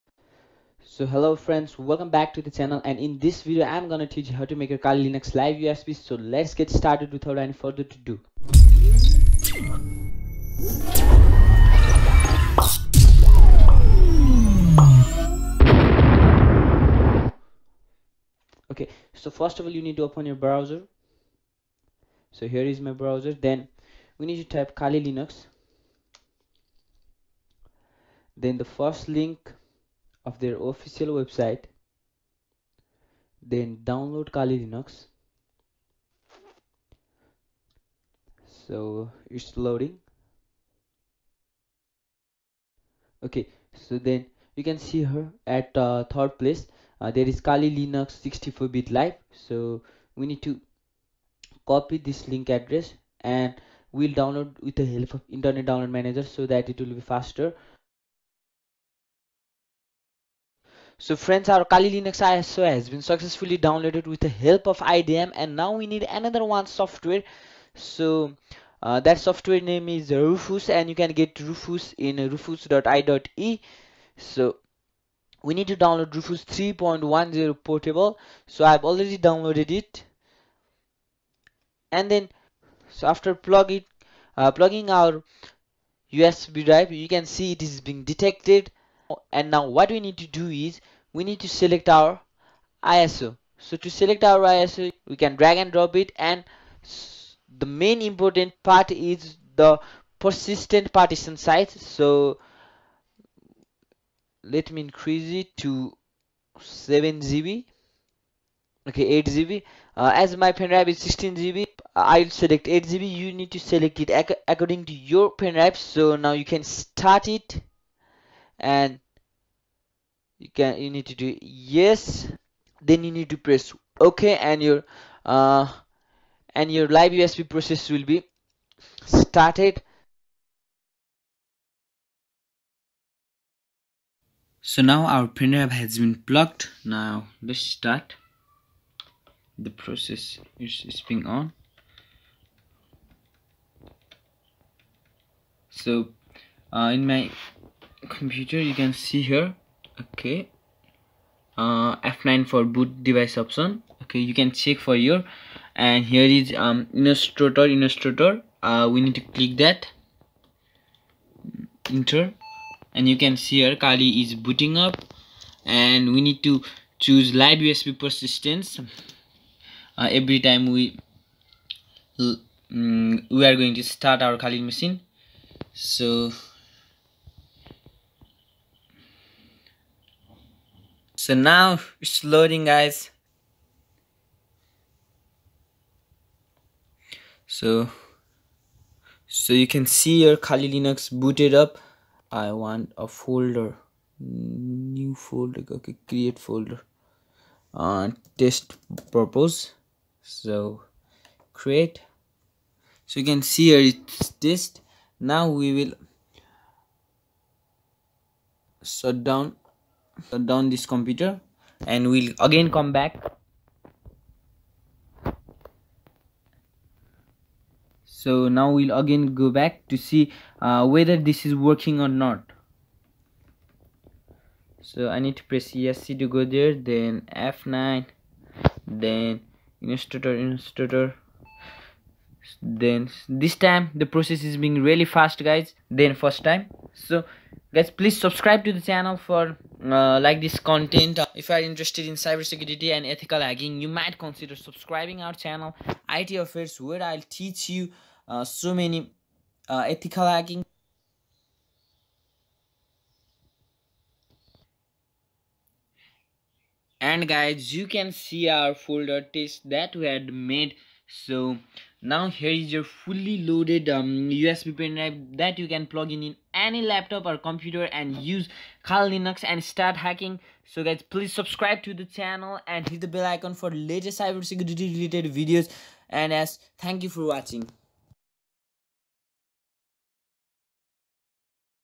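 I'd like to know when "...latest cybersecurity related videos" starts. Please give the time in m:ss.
4:33.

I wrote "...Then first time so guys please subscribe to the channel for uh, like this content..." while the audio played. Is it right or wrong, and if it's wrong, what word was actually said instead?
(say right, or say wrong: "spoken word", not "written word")
right.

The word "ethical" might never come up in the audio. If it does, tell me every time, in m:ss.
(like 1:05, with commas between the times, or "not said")
4:03, 4:09.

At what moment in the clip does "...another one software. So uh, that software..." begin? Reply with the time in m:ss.
1:06.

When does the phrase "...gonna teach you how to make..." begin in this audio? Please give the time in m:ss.
0:03.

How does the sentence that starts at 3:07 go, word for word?
So so you can see your Kali Linux booted up.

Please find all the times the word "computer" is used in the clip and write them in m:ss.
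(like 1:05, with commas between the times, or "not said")
2:28, 3:30, 4:27.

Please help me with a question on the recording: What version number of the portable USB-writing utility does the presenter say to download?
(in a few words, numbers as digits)
3.10.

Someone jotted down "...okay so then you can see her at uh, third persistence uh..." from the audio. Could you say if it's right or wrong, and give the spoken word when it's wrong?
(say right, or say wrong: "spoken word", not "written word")
wrong: "place", not "persistence".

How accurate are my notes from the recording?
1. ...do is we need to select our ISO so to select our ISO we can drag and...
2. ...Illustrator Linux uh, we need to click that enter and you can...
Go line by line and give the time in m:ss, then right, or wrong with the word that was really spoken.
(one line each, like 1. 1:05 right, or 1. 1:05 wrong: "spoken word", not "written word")
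1. 1:30 right
2. 2:36 wrong: "Illustrator", not "Linux".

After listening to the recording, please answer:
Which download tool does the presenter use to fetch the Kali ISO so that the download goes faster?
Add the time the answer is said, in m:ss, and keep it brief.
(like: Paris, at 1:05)
Internet Download Manager, at 0:55.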